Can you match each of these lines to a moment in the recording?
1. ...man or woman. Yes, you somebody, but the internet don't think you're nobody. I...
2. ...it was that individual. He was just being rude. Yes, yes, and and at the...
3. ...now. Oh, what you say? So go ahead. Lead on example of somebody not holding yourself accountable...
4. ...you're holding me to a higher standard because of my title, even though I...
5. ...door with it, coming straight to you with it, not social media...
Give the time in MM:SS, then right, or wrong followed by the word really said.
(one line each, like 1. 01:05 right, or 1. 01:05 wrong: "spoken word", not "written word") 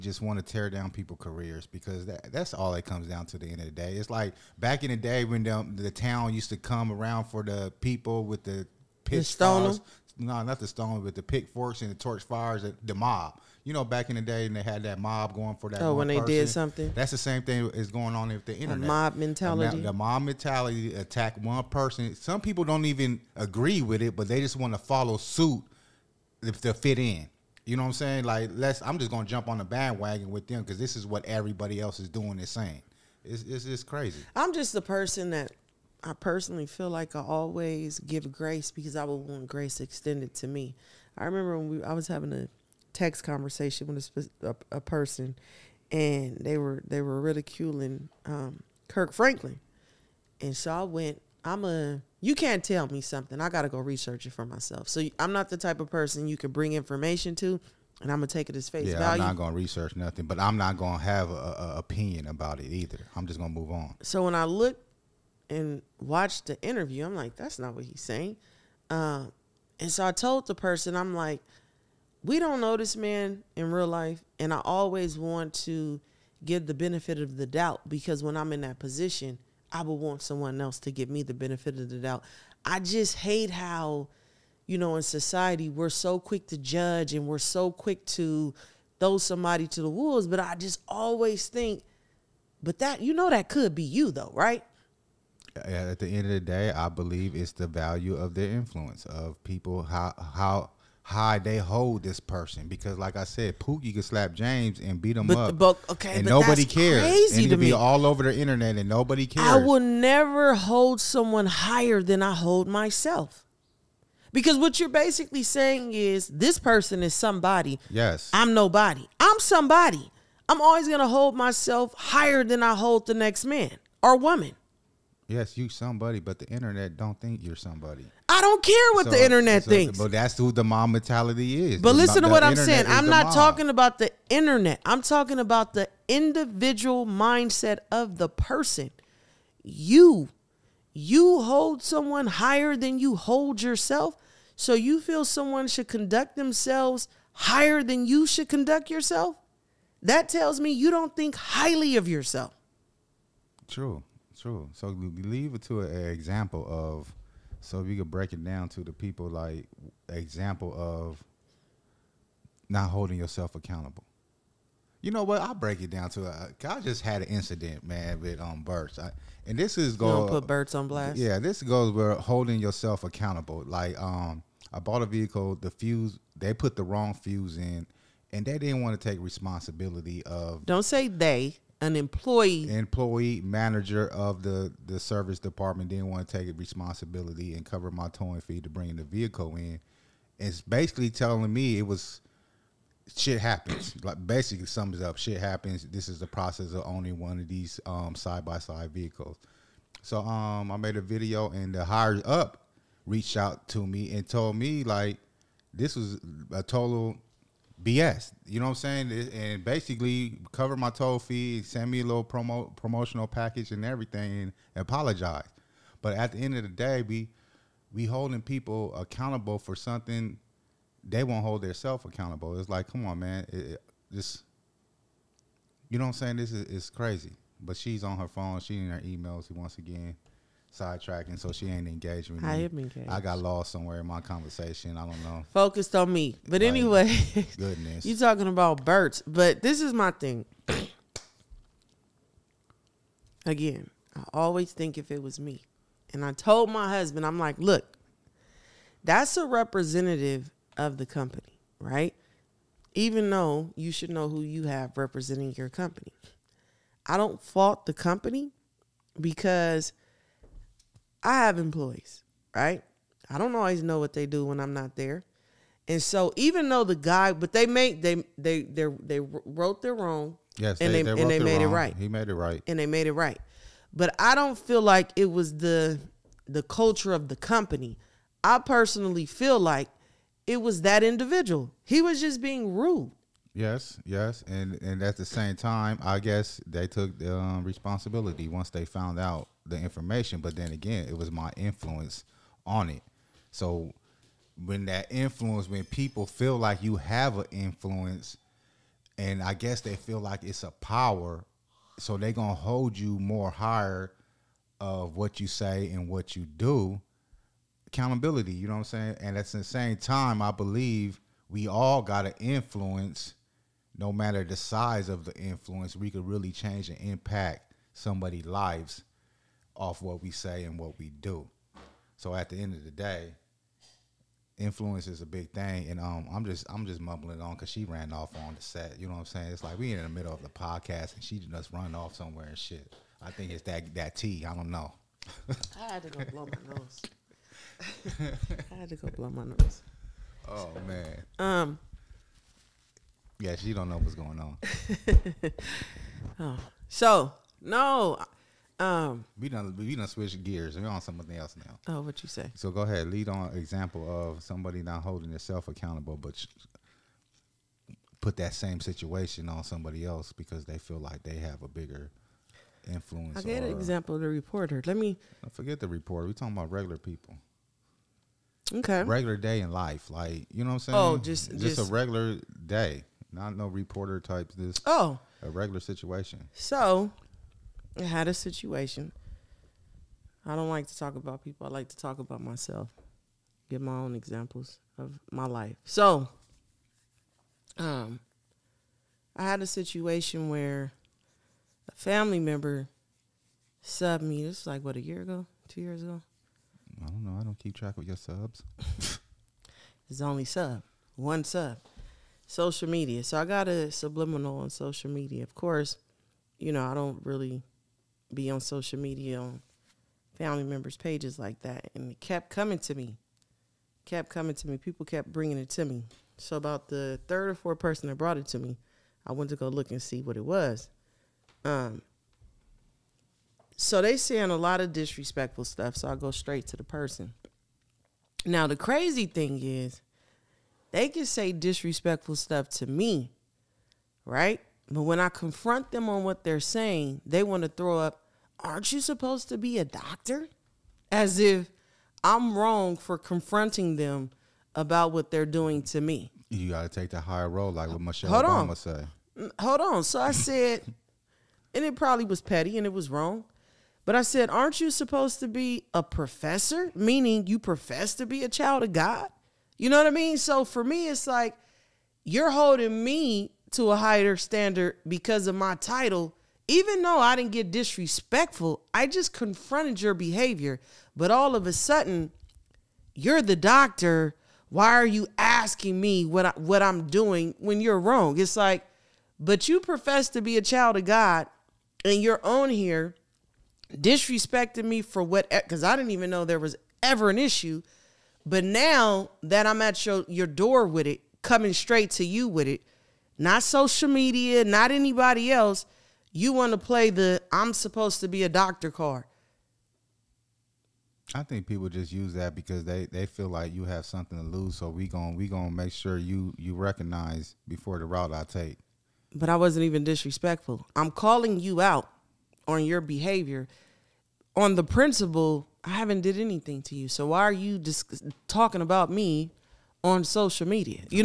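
1. 02:03 wrong: "somebody", not "nobody"
2. 04:40 right
3. 05:51 right
4. 07:42 right
5. 08:10 right.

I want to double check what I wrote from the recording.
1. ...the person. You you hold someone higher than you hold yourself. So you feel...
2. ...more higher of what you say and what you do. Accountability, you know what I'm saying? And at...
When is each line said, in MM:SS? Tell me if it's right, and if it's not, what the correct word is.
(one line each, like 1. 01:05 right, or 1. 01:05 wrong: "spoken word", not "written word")
1. 02:18 right
2. 05:03 right.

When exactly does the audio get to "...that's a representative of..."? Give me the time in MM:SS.
04:09.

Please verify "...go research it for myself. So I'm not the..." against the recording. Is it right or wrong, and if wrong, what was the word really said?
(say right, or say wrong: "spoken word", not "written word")
right.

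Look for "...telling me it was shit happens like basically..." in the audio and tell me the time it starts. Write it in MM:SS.
03:11.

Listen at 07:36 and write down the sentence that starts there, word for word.
Meaning you profess to be a child of God?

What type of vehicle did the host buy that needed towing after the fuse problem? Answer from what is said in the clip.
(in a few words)
side-by-side.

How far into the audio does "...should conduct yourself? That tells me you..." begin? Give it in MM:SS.
02:28.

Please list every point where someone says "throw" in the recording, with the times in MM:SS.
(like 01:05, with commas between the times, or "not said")
01:28, 07:17.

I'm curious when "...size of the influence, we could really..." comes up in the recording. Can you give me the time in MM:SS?
05:14.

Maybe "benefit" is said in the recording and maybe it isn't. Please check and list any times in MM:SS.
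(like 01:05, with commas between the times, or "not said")
01:16, 01:21.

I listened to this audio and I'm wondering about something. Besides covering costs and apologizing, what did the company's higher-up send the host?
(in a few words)
promotional package.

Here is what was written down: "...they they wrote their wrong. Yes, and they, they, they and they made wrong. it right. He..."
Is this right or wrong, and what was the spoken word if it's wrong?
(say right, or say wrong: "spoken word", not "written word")
right.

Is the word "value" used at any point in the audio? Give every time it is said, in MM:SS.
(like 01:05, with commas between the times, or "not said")
00:58, 01:37.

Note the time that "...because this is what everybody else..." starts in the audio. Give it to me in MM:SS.
00:30.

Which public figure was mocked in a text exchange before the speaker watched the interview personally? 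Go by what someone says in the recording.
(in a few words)
Kirk Franklin.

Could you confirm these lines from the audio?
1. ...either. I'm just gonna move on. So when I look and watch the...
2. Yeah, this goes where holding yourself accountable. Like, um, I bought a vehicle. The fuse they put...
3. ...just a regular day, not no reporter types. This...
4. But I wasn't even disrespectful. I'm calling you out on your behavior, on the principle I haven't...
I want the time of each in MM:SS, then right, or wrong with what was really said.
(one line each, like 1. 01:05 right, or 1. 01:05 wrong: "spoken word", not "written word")
1. 01:02 right
2. 02:51 right
3. 06:11 right
4. 08:29 right.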